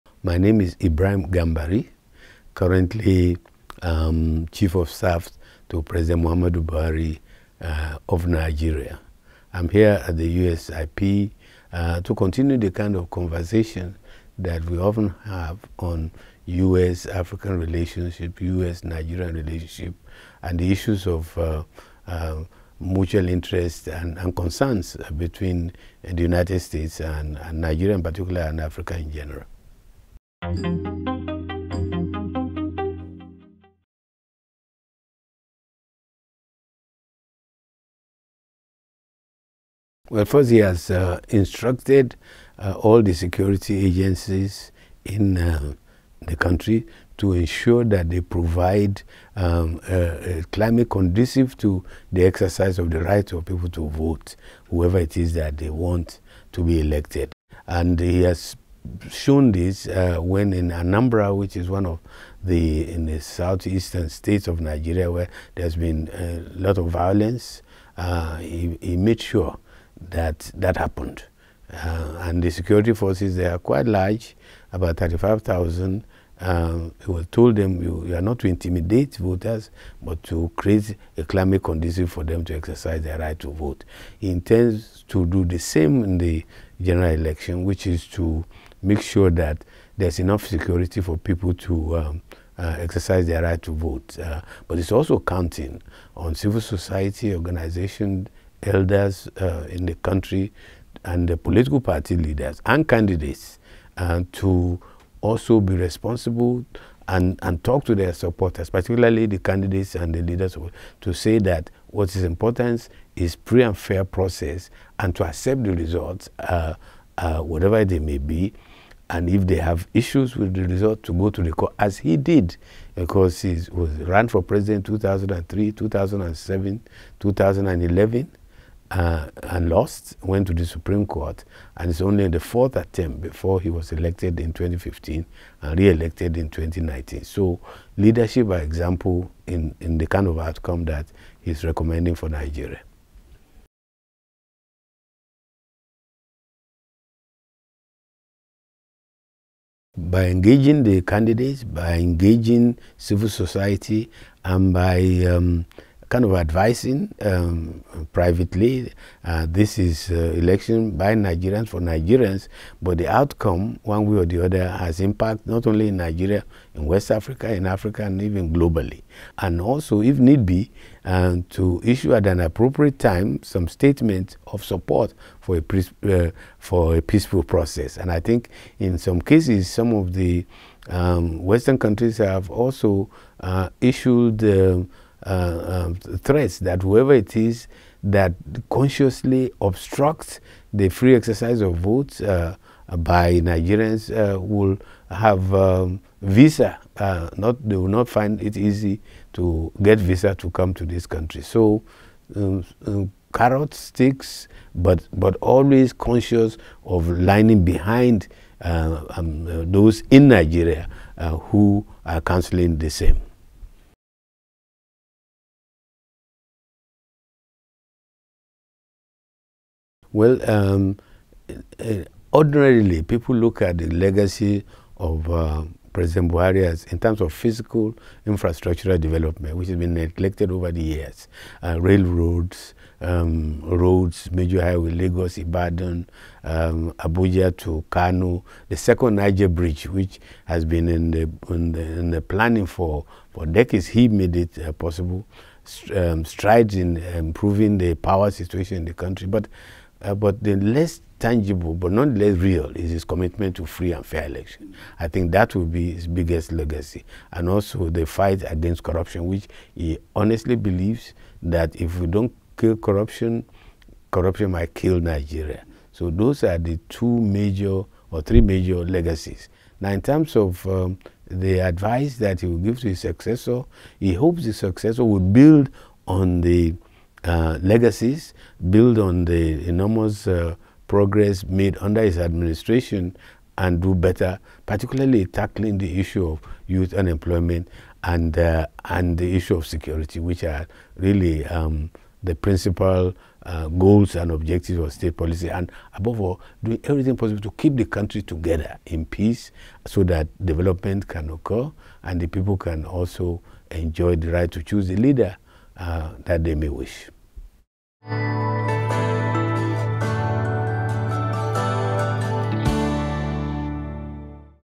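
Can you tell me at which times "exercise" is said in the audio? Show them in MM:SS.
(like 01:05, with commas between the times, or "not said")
00:52, 01:22, 01:32, 03:11.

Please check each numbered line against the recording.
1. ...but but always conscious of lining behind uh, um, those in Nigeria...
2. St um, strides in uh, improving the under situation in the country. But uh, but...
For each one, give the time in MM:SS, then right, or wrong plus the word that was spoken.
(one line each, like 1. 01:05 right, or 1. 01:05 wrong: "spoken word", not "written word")
1. 03:24 right
2. 04:05 wrong: "power", not "under".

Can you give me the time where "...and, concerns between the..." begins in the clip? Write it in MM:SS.
00:24.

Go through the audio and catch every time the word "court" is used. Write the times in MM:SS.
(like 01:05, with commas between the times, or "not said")
02:01, 02:11.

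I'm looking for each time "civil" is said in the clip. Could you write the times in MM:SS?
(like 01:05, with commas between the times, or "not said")
01:36, 02:32.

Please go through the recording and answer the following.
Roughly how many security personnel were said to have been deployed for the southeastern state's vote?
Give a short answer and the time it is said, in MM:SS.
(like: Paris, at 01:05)
35,000, at 01:14.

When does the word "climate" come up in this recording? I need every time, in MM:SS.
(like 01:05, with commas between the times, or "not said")
00:50, 01:21.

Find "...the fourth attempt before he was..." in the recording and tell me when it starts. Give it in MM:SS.
02:12.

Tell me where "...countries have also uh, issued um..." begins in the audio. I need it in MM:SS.
03:01.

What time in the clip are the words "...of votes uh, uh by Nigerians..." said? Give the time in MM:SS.
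03:11.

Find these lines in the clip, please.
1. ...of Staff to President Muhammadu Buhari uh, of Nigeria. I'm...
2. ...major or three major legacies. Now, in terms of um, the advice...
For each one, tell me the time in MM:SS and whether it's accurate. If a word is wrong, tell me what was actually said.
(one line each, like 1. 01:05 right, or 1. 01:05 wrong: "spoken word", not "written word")
1. 00:04 right
2. 04:27 right.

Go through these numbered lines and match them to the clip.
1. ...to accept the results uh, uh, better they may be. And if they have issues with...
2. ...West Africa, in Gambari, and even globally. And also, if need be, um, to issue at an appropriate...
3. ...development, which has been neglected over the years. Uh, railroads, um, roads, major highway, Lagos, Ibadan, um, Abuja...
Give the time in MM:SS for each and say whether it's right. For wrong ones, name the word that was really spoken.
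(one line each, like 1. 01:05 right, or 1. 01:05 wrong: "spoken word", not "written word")
1. 01:55 wrong: "whatever", not "better"
2. 02:46 wrong: "Africa", not "Gambari"
3. 03:48 right.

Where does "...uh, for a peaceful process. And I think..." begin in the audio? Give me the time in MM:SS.
02:56.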